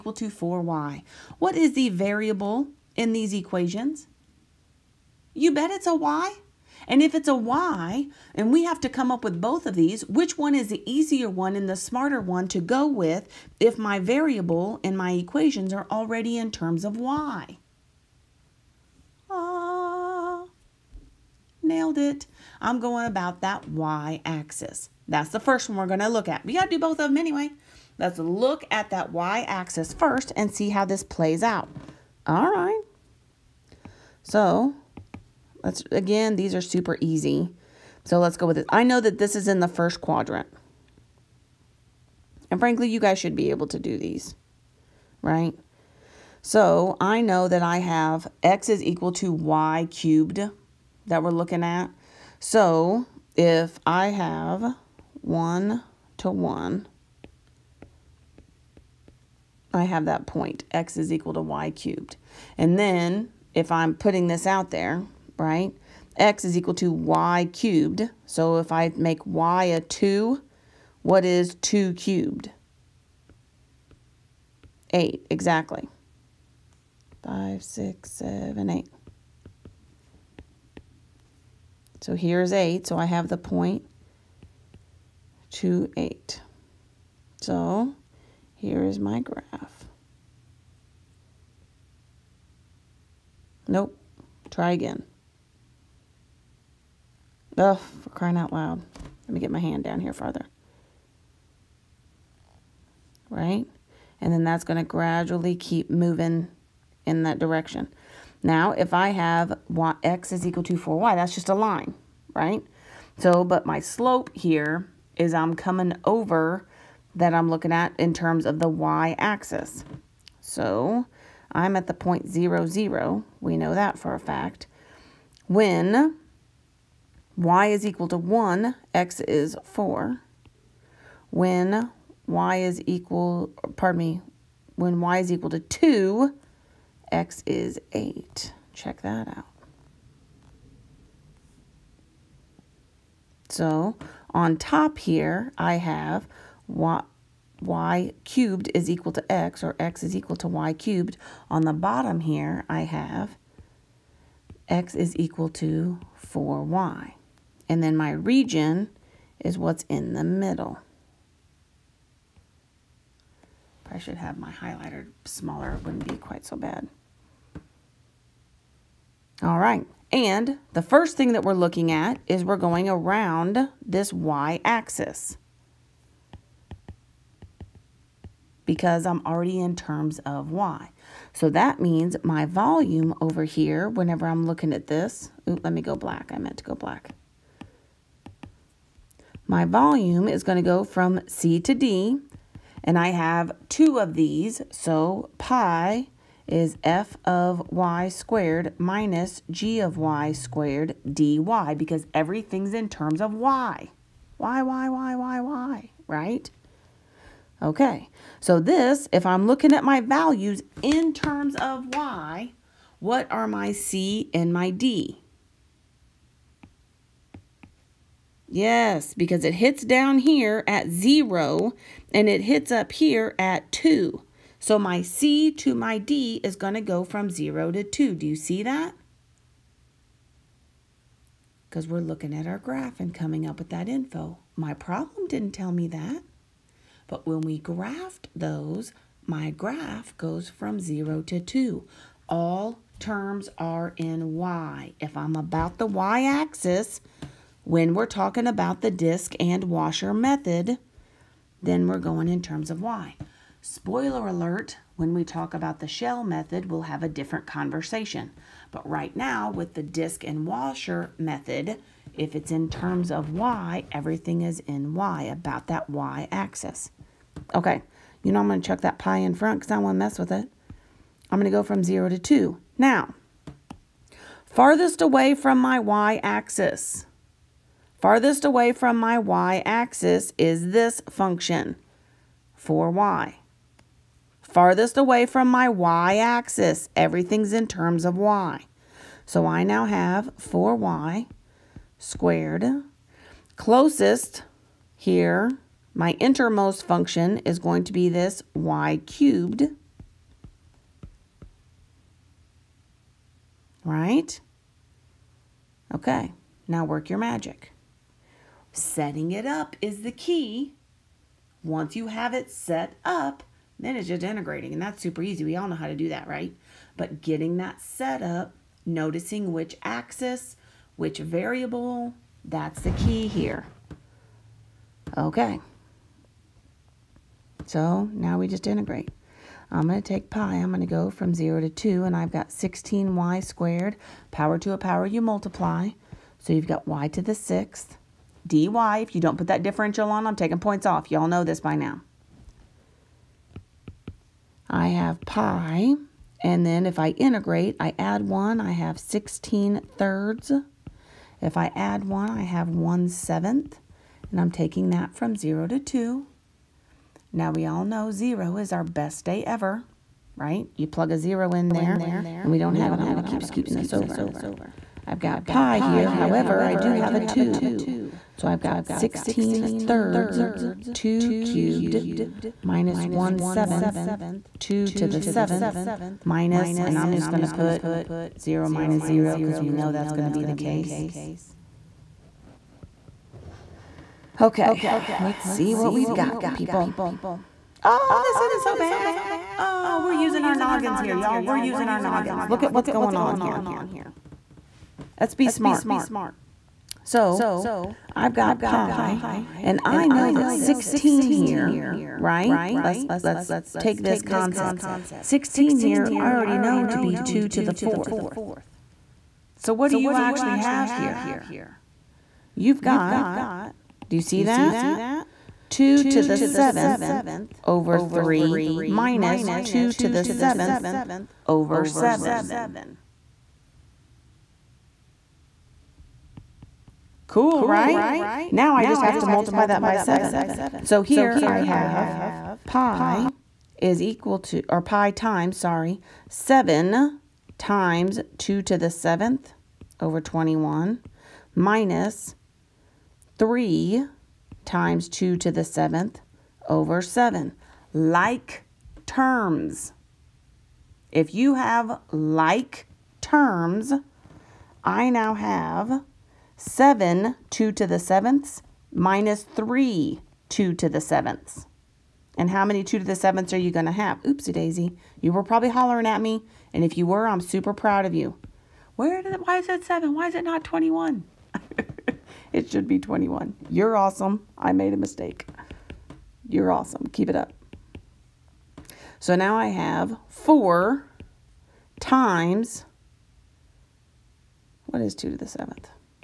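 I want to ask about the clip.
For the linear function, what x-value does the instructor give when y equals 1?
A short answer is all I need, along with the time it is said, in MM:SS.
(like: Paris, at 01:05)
4, at 02:05.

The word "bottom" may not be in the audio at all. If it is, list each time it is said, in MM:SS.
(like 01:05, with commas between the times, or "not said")
02:31.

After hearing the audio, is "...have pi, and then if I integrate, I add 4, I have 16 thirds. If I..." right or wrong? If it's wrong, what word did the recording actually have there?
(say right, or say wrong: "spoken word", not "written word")
wrong: "1", not "4".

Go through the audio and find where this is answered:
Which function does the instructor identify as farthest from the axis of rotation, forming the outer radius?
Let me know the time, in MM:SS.
04:50.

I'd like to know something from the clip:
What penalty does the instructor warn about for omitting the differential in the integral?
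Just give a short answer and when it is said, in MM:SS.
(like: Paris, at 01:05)
taking points off, at 05:40.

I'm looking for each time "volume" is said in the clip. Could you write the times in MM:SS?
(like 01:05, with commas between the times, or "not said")
03:02, 03:09.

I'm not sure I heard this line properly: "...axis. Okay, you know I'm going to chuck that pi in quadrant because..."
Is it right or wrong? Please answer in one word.
wrong.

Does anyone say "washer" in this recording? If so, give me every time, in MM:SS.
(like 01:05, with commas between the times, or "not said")
04:09, 04:20.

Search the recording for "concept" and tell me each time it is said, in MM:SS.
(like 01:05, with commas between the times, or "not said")
06:44.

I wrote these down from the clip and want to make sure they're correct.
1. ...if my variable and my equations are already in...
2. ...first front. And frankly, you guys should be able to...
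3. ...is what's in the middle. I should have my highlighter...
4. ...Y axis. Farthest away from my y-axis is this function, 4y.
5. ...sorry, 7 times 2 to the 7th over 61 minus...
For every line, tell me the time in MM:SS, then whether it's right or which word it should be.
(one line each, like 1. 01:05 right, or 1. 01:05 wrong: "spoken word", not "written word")
1. 00:13 right
2. 00:39 wrong: "quadrant", not "front"
3. 02:39 right
4. 04:35 right
5. 07:15 wrong: "21", not "61".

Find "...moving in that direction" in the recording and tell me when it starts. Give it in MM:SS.
01:45.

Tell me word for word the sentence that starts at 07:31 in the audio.
If you have like terms, I now have 7 2 to the 7ths minus 3 2 to the 7ths.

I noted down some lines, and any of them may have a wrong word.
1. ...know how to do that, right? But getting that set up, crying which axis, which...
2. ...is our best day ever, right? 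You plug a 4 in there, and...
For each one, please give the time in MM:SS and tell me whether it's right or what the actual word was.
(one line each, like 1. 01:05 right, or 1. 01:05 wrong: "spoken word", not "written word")
1. 05:15 wrong: "noticing", not "crying"
2. 05:58 wrong: "0", not "4".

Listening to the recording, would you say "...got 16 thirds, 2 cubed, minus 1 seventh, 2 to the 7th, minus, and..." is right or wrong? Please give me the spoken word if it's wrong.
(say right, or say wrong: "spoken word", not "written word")
right.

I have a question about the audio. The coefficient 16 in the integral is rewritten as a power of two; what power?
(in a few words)
2 to the 4th.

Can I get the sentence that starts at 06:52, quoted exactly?
You've got, do you see that?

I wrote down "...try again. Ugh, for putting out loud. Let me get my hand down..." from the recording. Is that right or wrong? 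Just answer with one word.
wrong.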